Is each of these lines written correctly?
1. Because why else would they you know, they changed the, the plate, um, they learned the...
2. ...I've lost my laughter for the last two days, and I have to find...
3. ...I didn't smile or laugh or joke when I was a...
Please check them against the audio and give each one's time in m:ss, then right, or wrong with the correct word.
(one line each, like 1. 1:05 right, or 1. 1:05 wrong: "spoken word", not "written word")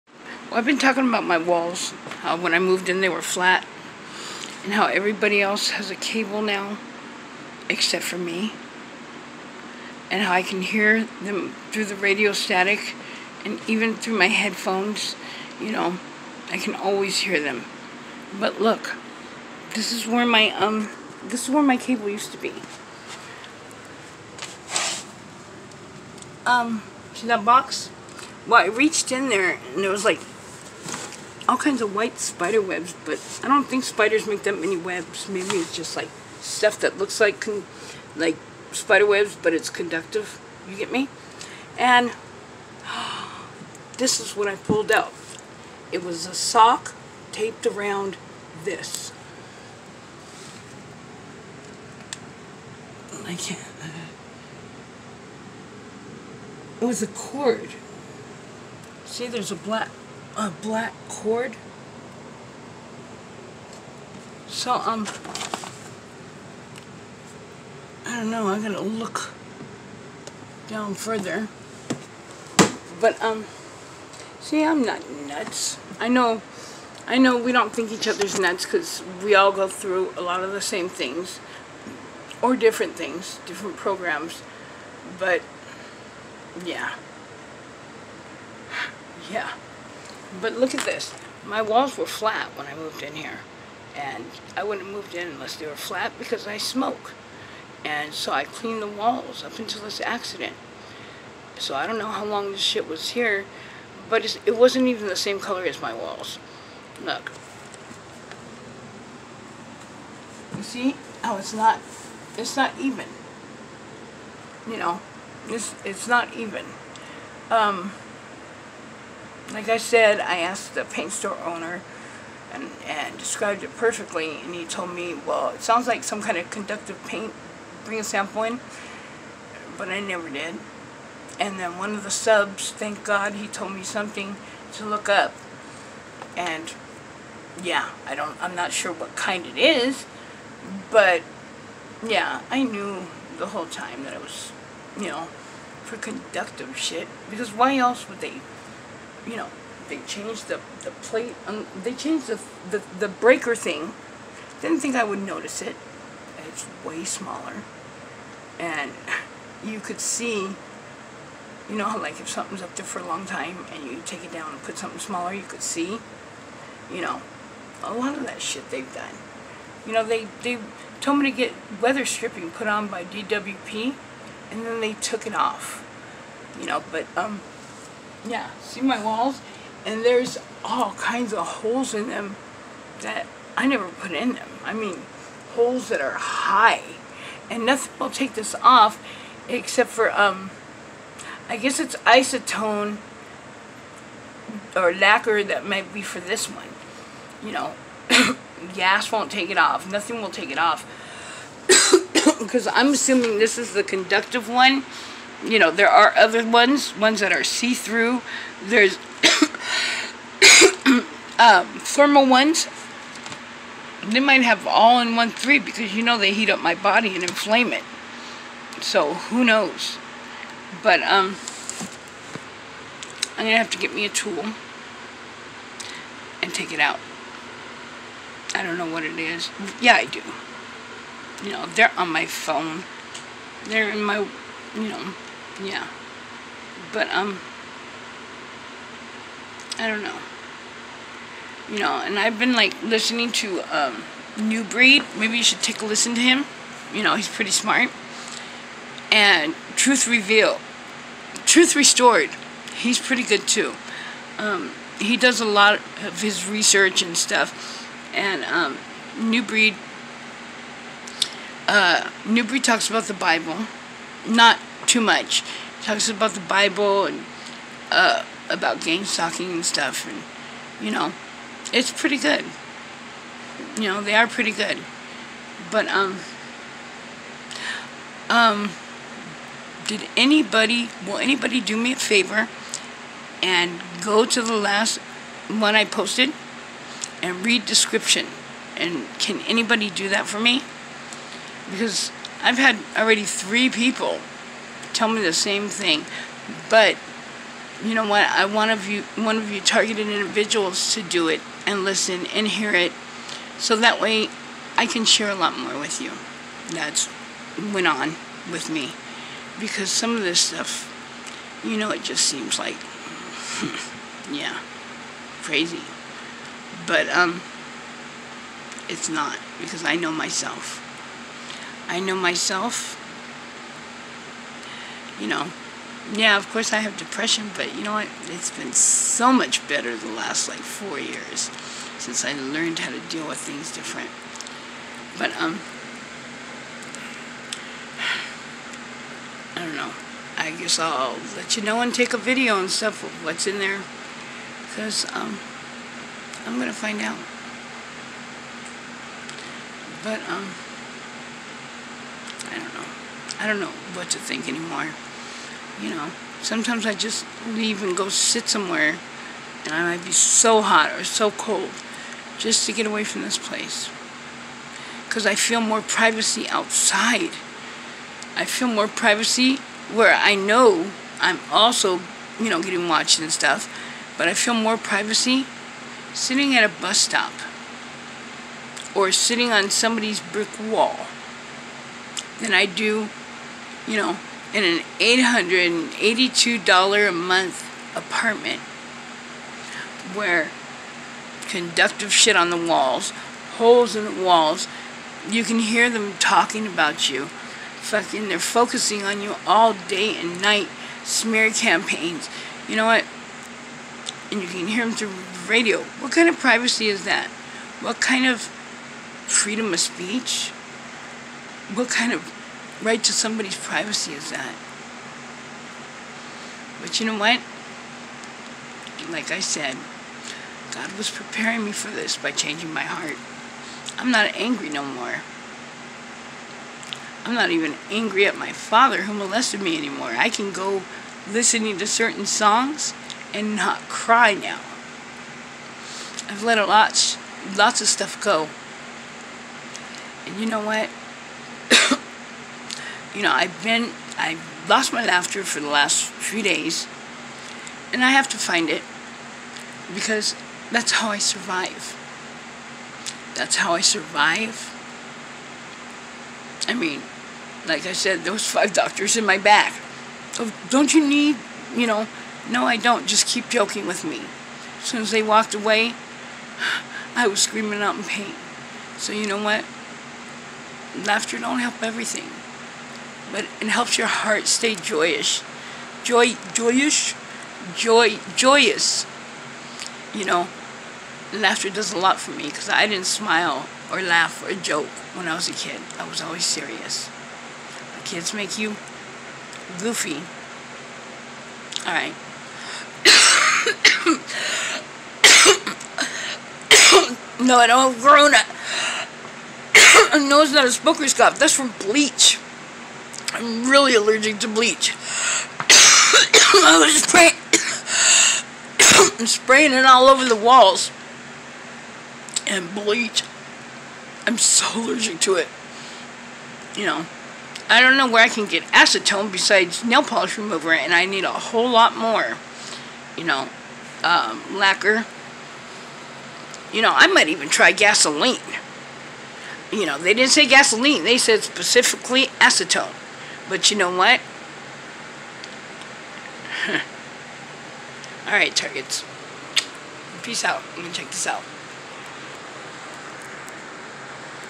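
1. 2:27 wrong: "changed", not "learned"
2. 7:24 wrong: "three", not "two"
3. 8:02 right.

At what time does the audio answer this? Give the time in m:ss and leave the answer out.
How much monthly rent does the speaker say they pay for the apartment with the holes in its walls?
6:24.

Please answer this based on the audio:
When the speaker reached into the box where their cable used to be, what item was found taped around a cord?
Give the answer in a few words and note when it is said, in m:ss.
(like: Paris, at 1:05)
A sock, at 0:46.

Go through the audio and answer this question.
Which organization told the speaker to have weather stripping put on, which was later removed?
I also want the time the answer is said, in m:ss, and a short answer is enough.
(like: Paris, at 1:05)
DWP, at 2:53.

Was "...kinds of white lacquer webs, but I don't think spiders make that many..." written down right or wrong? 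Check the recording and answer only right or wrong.
wrong.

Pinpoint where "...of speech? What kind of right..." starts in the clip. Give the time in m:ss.
6:49.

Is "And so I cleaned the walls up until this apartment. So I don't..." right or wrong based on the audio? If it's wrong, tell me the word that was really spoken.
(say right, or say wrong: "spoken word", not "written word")
wrong: "accident", not "apartment".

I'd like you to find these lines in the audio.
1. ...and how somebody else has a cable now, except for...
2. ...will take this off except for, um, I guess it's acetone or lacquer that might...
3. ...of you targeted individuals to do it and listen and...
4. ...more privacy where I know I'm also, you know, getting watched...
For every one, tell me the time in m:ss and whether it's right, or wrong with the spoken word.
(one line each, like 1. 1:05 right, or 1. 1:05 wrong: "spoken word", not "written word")
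1. 0:04 wrong: "everybody", not "somebody"
2. 3:07 right
3. 4:59 right
4. 6:08 right.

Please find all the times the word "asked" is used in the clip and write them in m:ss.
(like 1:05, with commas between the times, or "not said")
2:00.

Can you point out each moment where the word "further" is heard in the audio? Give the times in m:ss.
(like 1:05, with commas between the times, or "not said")
1:10.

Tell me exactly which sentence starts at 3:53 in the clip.
They're in my, you know, yeah.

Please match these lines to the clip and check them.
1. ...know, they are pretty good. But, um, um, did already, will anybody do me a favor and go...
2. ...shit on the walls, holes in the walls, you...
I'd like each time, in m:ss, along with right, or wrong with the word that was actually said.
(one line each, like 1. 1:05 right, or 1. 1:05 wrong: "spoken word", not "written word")
1. 4:33 wrong: "anybody", not "already"
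2. 6:32 right.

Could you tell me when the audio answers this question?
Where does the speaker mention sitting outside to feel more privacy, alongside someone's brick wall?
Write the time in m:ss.
6:16.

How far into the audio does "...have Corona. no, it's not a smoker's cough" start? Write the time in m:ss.
8:17.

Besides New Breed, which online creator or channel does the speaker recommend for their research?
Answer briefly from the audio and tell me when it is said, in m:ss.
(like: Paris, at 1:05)
Truth Revealed, at 4:09.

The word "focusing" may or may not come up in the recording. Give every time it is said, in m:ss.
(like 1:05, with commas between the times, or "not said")
6:38.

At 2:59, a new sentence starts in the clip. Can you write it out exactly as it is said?
And there's all kinds of holes in them that I never put in them.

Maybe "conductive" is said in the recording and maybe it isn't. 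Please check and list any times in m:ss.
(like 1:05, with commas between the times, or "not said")
0:39, 2:06, 2:25, 3:23, 6:31.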